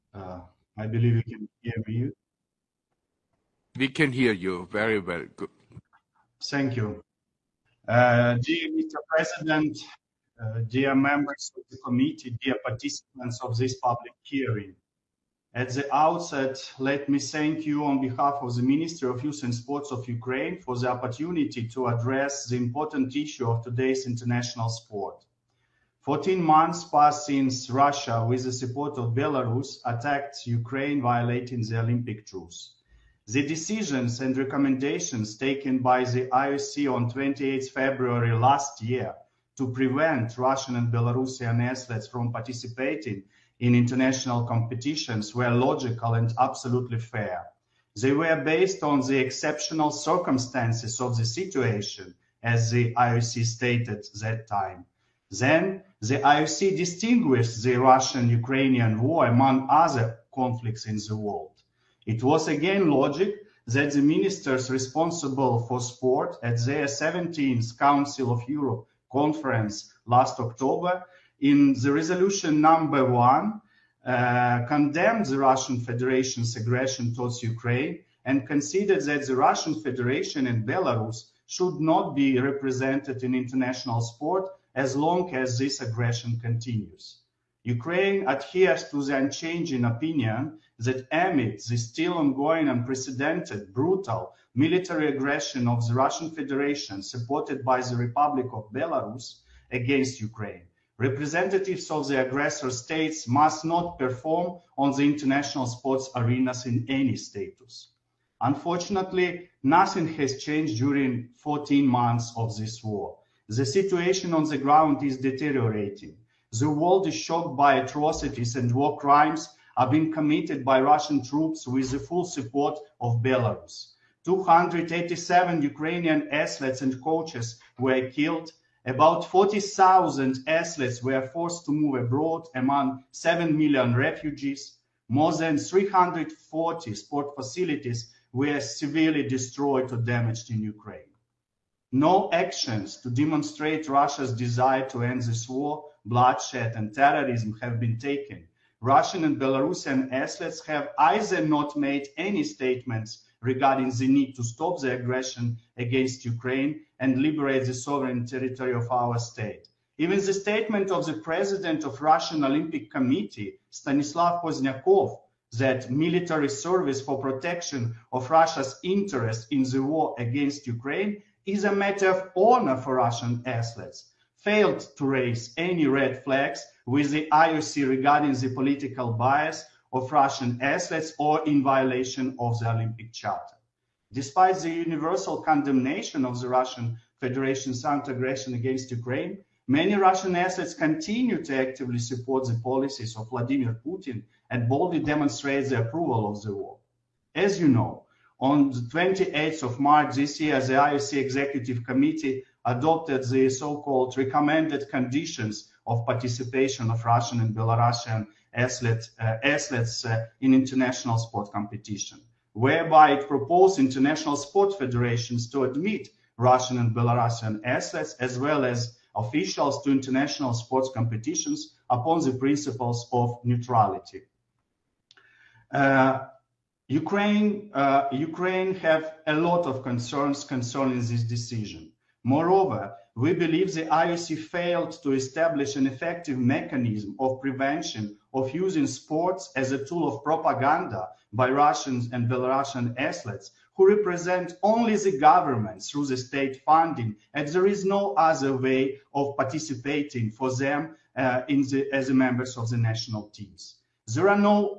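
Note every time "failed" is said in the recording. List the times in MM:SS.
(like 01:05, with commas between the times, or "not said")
02:54, 03:54.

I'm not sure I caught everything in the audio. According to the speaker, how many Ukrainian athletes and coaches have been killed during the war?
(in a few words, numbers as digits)
287.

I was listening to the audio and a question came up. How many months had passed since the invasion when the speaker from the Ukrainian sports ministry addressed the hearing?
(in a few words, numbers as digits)
14.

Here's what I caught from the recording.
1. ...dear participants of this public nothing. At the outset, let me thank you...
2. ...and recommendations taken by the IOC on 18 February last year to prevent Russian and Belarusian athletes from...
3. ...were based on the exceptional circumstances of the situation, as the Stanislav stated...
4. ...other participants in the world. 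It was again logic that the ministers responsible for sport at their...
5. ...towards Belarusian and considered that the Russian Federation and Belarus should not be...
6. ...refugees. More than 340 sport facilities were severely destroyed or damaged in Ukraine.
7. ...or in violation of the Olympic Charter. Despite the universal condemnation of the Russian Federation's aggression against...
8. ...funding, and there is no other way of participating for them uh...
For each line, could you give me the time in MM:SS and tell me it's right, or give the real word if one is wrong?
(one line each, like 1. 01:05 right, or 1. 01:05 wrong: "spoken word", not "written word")
1. 00:12 wrong: "hearing", not "nothing"
2. 00:34 wrong: "28", not "18"
3. 00:48 wrong: "IOC", not "Stanislav"
4. 00:59 wrong: "conflicts", not "participants"
5. 01:17 wrong: "Ukraine", not "Belarusian"
6. 02:13 right
7. 03:01 right
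8. 04:06 right.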